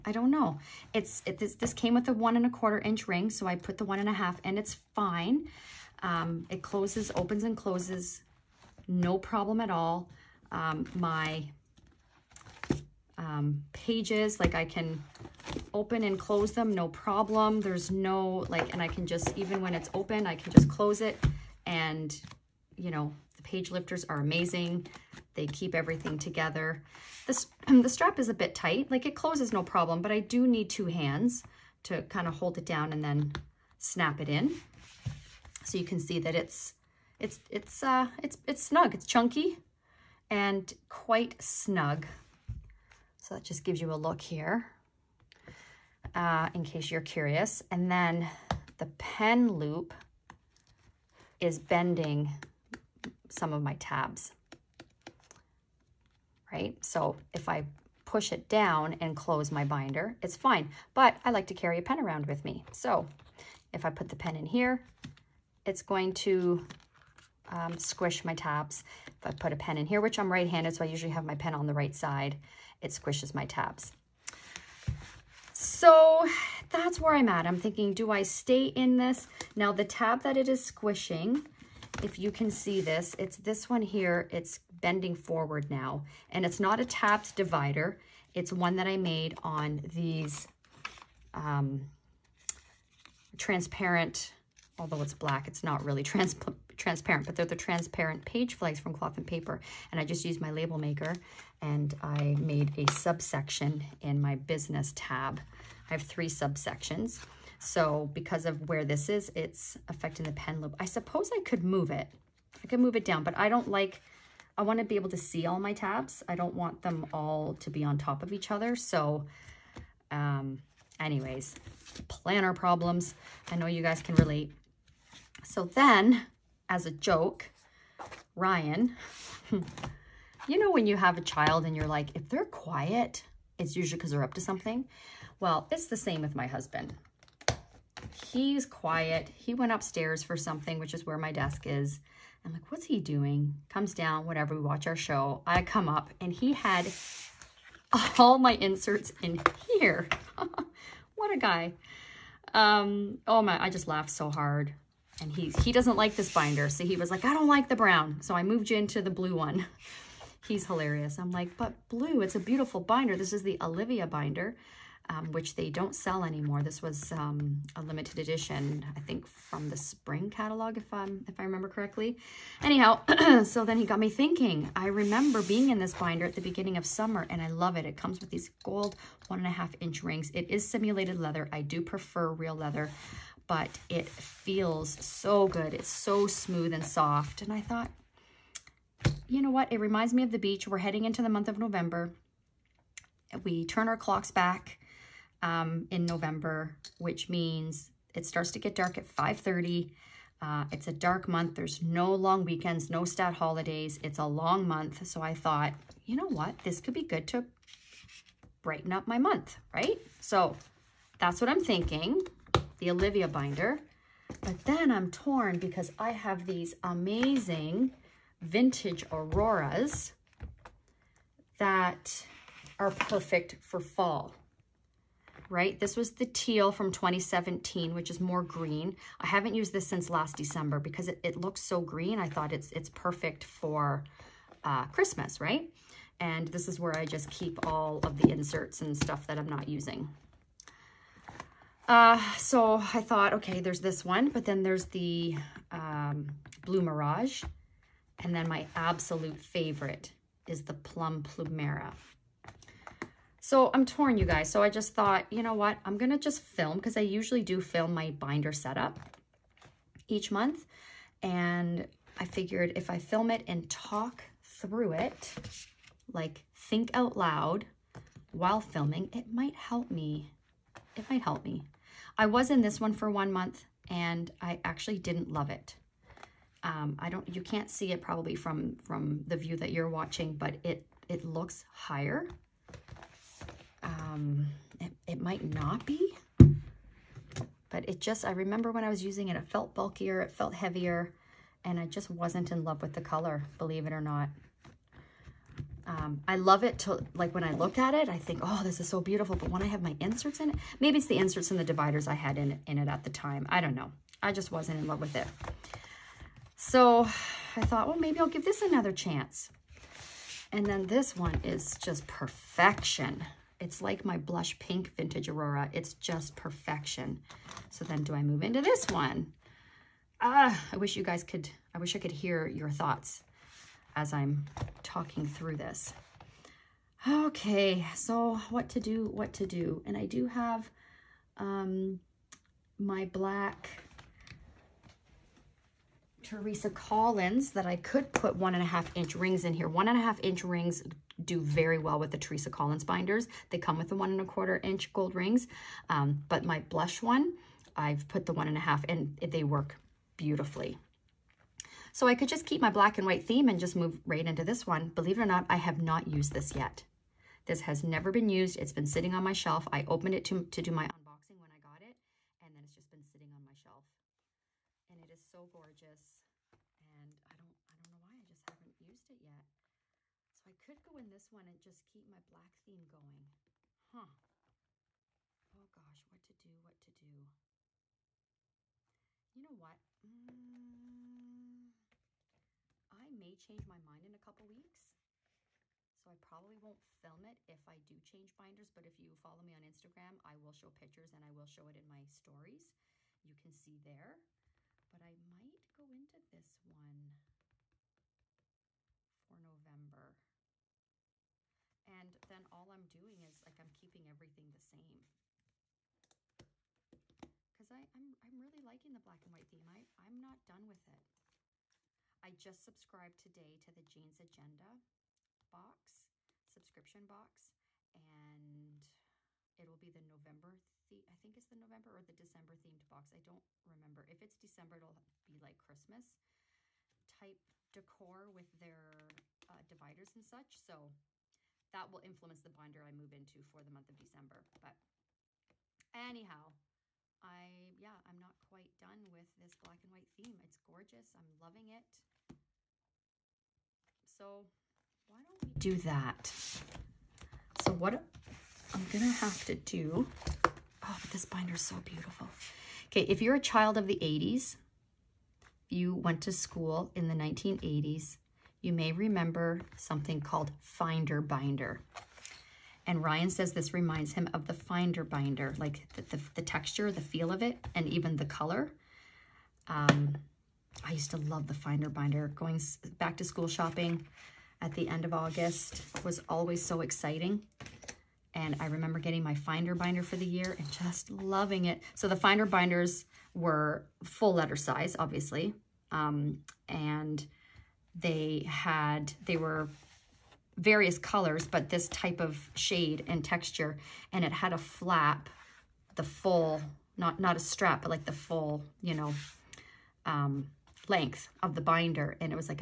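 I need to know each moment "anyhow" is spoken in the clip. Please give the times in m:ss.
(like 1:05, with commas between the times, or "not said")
2:52, 7:15.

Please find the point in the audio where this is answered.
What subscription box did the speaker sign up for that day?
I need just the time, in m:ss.
6:53.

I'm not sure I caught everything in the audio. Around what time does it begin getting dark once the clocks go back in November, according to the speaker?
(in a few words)
5:30.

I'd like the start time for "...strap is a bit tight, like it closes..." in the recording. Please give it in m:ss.
0:27.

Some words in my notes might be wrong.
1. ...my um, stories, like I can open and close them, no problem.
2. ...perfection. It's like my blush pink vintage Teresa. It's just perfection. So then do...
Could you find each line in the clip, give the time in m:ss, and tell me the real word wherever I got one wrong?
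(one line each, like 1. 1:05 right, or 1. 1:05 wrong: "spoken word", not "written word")
1. 0:10 wrong: "pages", not "stories"
2. 5:12 wrong: "Aurora", not "Teresa".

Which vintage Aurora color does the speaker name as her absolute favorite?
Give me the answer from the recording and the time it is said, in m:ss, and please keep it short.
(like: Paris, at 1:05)
Plum Plumera, at 4:10.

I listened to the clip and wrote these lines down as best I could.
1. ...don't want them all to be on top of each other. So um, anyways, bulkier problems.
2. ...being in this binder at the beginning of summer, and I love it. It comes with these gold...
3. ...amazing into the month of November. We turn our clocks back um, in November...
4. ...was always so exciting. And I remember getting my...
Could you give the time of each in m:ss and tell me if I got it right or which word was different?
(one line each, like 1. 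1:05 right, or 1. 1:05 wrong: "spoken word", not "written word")
1. 1:56 wrong: "planner", not "bulkier"
2. 2:55 right
3. 3:10 wrong: "heading", not "amazing"
4. 7:56 right.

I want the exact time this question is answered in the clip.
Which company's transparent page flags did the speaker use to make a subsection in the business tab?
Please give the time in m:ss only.
1:38.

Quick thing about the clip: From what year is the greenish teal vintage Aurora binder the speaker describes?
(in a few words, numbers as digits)
2017.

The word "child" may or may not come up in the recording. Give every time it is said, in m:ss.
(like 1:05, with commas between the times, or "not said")
2:11, 7:33.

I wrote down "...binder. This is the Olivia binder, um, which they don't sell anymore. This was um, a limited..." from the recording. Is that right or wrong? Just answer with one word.
right.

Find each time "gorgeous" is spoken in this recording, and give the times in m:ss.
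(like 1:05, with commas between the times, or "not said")
6:05, 7:20.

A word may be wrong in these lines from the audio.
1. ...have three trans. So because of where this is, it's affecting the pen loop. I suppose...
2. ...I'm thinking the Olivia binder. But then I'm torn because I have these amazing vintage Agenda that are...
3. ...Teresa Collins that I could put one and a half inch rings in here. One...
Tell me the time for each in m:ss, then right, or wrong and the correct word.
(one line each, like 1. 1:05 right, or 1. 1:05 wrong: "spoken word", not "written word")
1. 1:45 wrong: "subsections", not "trans"
2. 3:31 wrong: "Auroras", not "Agenda"
3. 5:36 right.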